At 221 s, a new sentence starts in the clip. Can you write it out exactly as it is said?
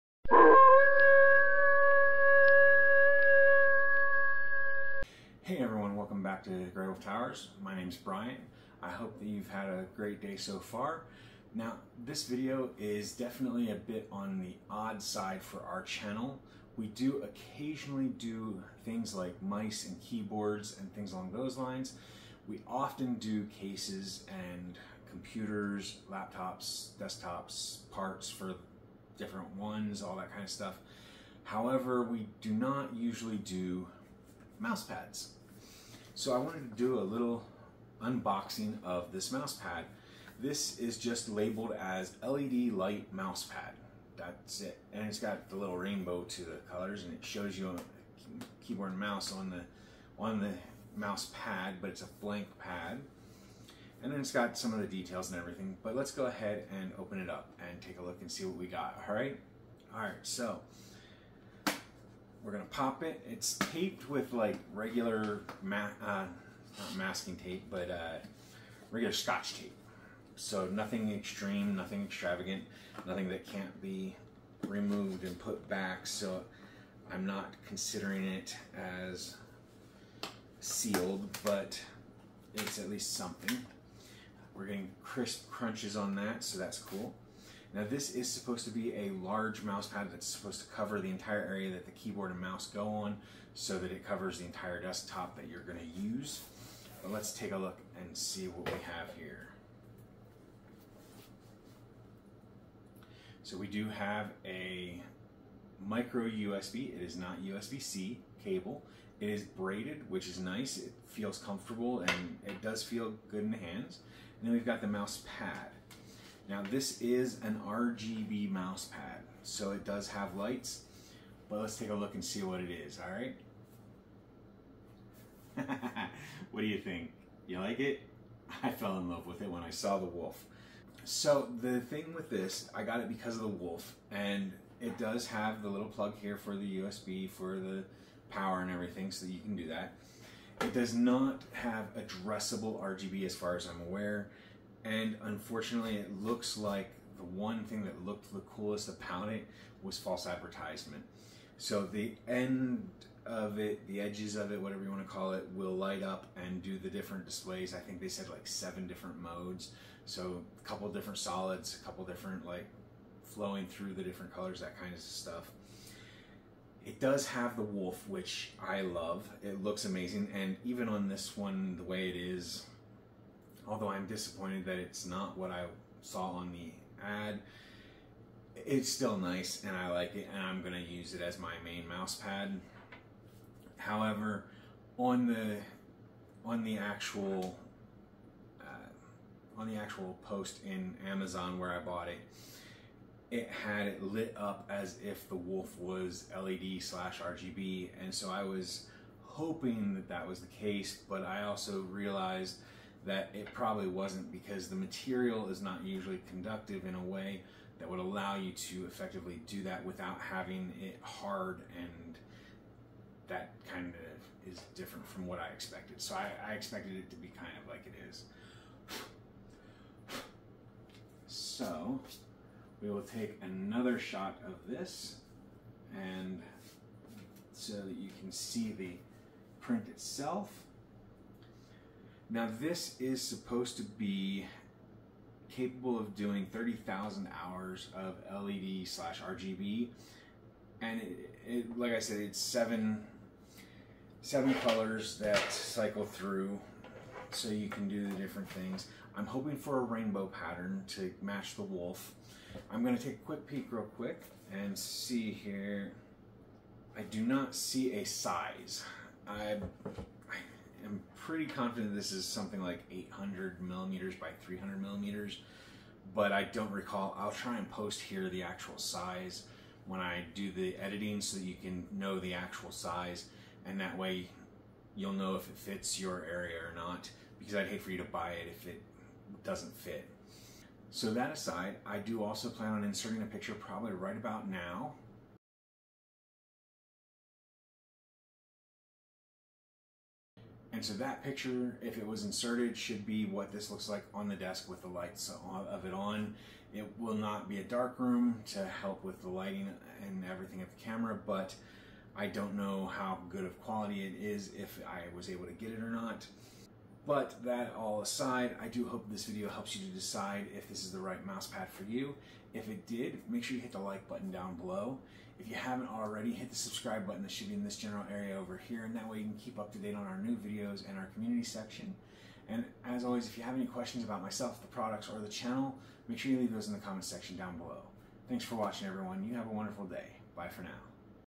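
So we will take another shot of this and so that you can see the print itself.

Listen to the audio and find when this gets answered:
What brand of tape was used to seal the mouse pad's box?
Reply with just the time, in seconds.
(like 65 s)
69 s.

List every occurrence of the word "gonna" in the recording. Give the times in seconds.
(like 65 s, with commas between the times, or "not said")
62 s, 95 s, 252 s.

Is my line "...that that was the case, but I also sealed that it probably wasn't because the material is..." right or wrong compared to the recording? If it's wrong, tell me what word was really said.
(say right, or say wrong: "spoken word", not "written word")
wrong: "realized", not "sealed".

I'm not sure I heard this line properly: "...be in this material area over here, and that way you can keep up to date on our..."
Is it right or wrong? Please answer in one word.
wrong.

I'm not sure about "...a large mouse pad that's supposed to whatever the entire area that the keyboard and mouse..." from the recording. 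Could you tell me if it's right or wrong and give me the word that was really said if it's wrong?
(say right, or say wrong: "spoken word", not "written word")
wrong: "cover", not "whatever".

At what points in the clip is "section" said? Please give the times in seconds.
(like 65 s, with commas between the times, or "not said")
321 s, 327 s.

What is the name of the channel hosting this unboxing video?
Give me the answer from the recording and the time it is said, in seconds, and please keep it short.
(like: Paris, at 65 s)
Grey Wolf Towers, at 6 s.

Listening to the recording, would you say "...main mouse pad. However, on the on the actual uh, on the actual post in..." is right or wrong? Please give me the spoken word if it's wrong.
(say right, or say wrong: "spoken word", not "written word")
right.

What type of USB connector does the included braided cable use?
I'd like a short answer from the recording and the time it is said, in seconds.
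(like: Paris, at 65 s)
Micro USB, at 105 s.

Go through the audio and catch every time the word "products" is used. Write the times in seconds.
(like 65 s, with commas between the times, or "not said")
324 s.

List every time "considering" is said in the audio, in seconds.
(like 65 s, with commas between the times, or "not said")
77 s.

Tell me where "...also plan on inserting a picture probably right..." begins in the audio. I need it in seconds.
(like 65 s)
282 s.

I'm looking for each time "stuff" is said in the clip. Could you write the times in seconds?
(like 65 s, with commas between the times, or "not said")
30 s, 164 s.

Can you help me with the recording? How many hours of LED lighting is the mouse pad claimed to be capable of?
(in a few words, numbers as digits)
30,000.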